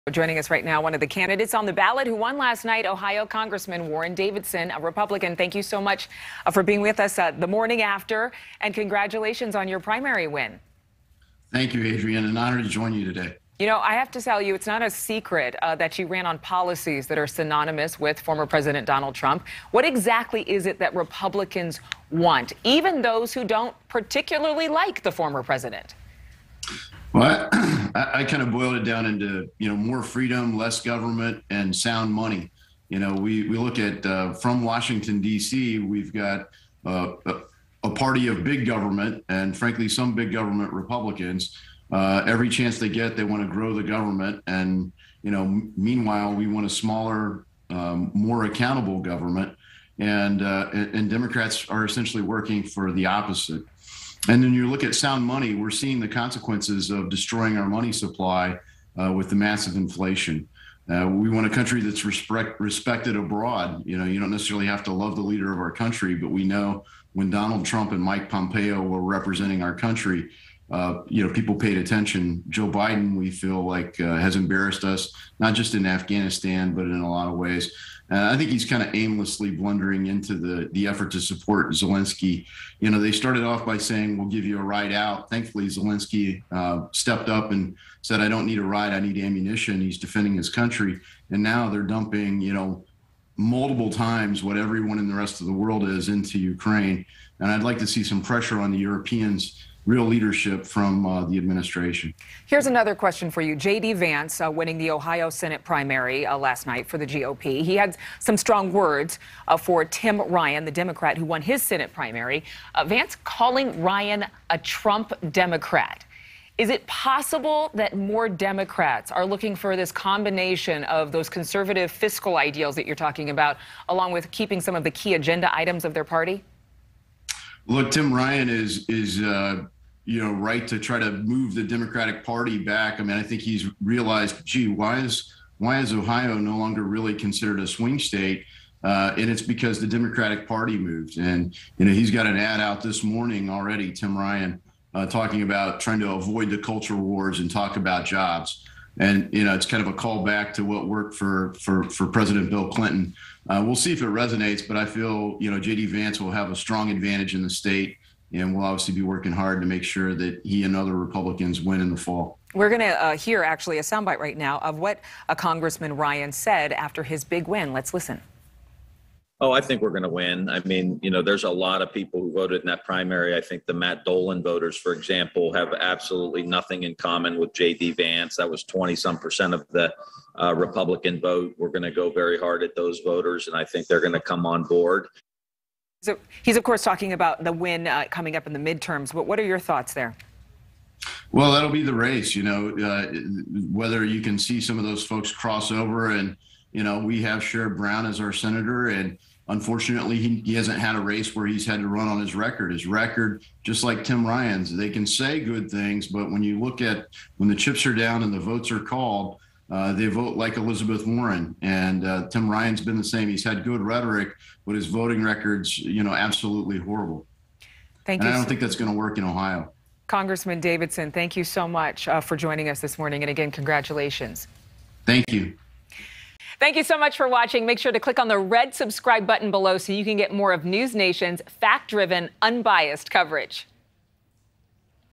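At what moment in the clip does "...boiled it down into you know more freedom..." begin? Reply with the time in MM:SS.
00:28.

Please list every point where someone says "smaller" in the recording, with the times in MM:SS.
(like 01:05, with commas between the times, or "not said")
00:46.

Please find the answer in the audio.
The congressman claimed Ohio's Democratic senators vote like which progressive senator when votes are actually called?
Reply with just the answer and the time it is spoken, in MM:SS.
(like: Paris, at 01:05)
Elizabeth Warren, at 03:30.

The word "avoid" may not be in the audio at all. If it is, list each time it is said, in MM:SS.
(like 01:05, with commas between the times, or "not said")
02:26.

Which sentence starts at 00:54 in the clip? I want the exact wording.
And then you look at sound money, we're seeing the consequences of destroying our money supply uh, with the massive inflation.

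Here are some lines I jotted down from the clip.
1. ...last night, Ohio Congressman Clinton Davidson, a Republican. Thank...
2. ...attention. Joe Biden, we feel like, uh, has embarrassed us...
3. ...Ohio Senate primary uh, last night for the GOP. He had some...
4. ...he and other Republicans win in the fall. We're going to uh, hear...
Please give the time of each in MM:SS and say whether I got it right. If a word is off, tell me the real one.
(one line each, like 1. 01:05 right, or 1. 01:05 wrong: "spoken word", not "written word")
1. 00:02 wrong: "Warren", not "Clinton"
2. 01:11 right
3. 01:44 right
4. 02:40 right.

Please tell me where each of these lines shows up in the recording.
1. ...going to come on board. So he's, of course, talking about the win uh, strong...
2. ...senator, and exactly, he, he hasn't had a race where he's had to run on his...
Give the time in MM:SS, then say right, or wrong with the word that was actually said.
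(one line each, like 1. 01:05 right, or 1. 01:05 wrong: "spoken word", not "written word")
1. 03:03 wrong: "coming", not "strong"
2. 03:18 wrong: "unfortunately", not "exactly".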